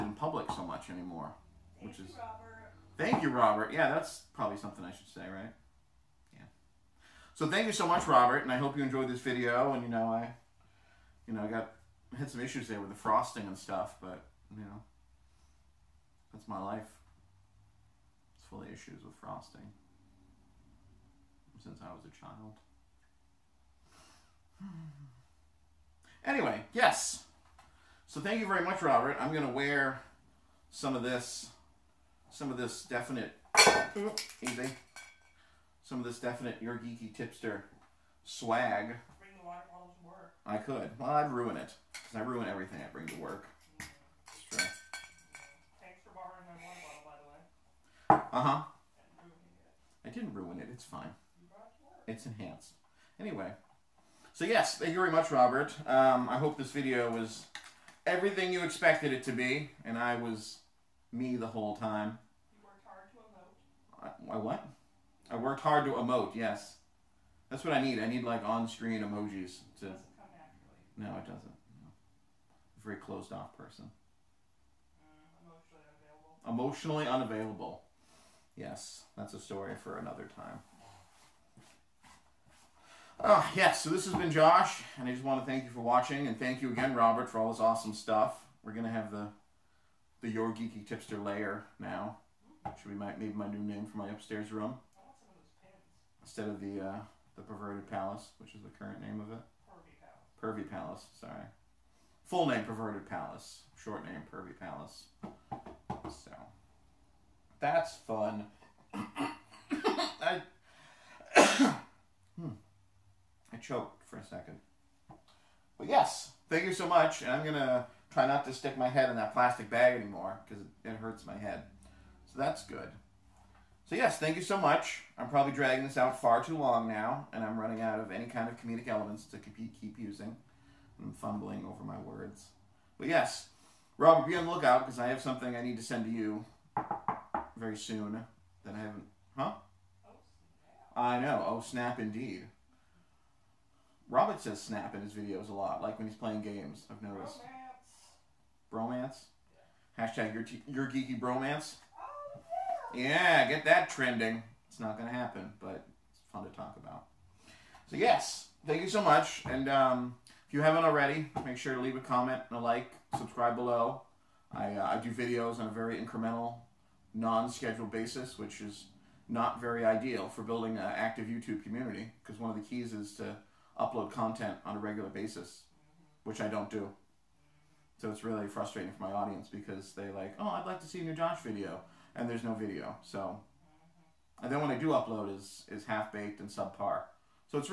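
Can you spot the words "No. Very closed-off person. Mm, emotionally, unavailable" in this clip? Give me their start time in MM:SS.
01:11.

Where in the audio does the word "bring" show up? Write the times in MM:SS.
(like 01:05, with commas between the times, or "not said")
00:38, 00:42.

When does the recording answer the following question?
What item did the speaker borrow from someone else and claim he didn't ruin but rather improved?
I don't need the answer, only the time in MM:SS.
00:46.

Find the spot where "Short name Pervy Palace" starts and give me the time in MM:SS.
01:43.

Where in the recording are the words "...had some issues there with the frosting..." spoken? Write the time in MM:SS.
00:12.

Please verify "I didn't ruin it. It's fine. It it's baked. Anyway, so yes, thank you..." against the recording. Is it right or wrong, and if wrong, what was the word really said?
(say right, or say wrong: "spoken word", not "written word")
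wrong: "enhanced", not "baked".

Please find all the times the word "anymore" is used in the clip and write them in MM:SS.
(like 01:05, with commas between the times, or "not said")
00:00, 01:59.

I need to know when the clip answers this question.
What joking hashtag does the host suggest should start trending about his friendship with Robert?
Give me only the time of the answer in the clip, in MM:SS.
02:30.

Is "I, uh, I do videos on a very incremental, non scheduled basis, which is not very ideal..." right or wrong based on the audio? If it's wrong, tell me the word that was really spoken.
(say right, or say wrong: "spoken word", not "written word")
right.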